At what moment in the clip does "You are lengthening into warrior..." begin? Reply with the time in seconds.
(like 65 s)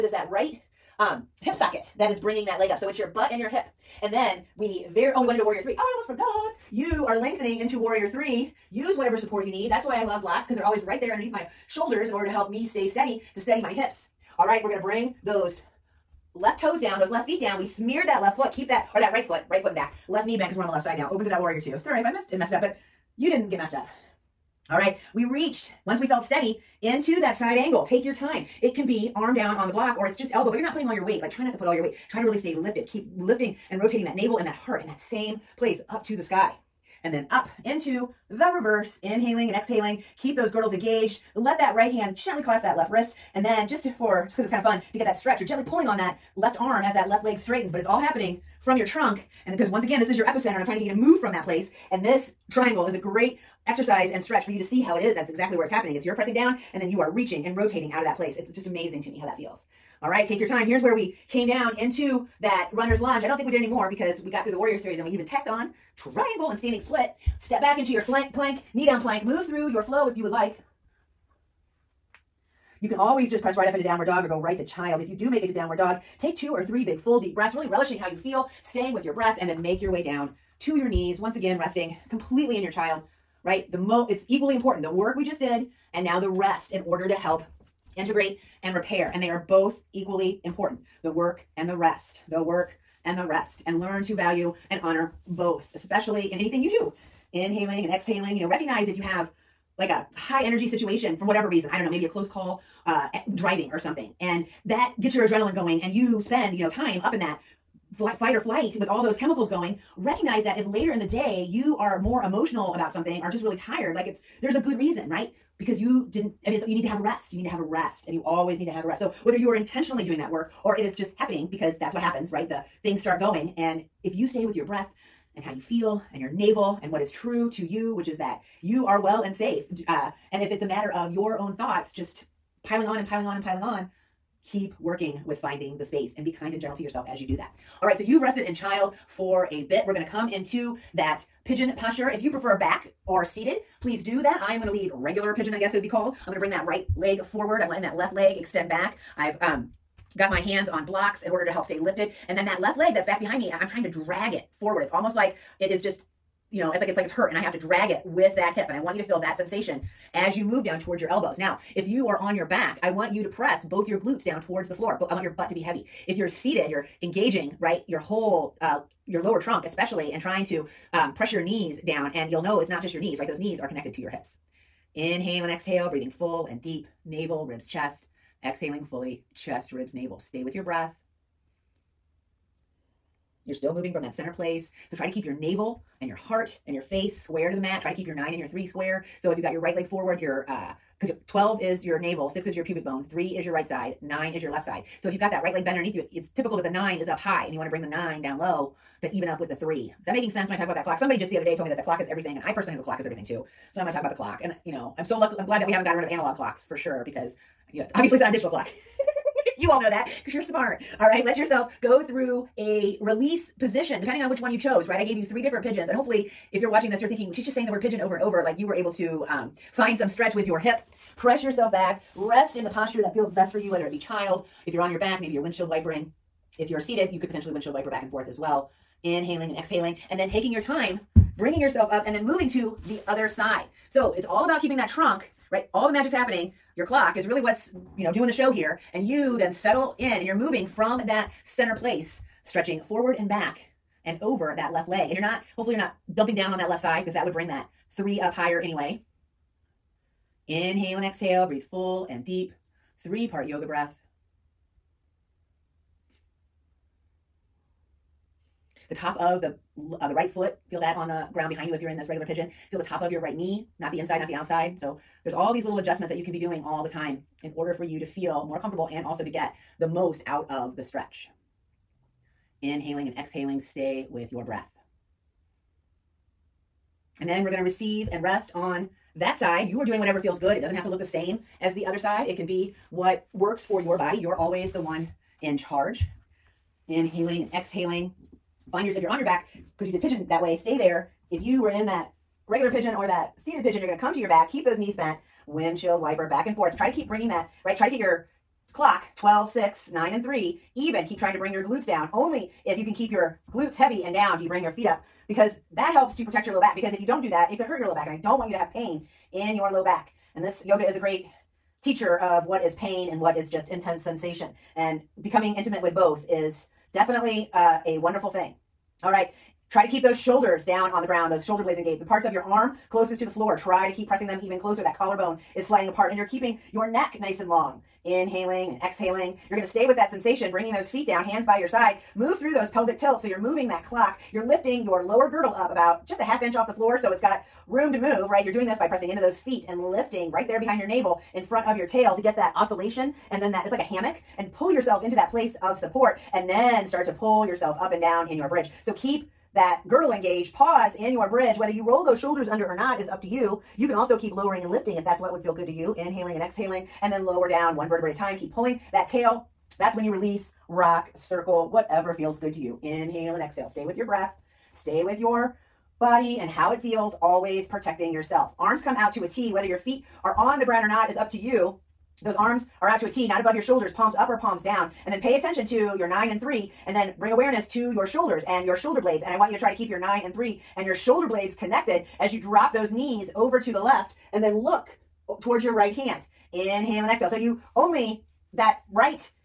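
6 s.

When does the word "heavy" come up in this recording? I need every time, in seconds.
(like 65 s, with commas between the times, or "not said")
165 s, 303 s.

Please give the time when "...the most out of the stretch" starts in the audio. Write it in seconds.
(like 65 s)
269 s.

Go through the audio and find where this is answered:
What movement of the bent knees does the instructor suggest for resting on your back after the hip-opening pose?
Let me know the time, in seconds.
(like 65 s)
225 s.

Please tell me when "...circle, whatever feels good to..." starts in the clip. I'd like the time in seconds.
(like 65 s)
361 s.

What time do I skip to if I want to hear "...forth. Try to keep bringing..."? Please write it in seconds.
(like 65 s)
296 s.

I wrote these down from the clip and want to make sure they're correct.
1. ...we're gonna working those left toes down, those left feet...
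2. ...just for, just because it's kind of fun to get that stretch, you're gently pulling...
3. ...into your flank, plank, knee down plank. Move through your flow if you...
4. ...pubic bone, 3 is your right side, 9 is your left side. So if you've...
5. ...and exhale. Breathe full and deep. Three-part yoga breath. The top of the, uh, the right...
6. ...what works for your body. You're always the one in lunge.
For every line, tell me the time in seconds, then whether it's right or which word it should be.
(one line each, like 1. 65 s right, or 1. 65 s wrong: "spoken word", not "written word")
1. 14 s wrong: "bring", not "working"
2. 43 s right
3. 67 s right
4. 192 s right
5. 250 s right
6. 282 s wrong: "charge", not "lunge".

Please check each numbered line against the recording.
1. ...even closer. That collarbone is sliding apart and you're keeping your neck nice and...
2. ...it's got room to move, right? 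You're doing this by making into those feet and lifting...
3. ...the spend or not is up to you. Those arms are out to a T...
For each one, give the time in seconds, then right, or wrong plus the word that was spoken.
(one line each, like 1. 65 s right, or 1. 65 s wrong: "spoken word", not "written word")
1. 324 s right
2. 337 s wrong: "pressing", not "making"
3. 370 s wrong: "ground", not "spend".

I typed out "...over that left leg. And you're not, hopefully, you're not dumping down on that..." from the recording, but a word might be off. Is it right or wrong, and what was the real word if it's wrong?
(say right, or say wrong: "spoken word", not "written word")
right.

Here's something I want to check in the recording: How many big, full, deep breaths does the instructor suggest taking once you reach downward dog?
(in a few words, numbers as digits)
2 or 3.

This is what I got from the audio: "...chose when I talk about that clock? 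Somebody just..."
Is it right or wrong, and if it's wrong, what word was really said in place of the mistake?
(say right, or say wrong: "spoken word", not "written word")
wrong: "sense", not "chose".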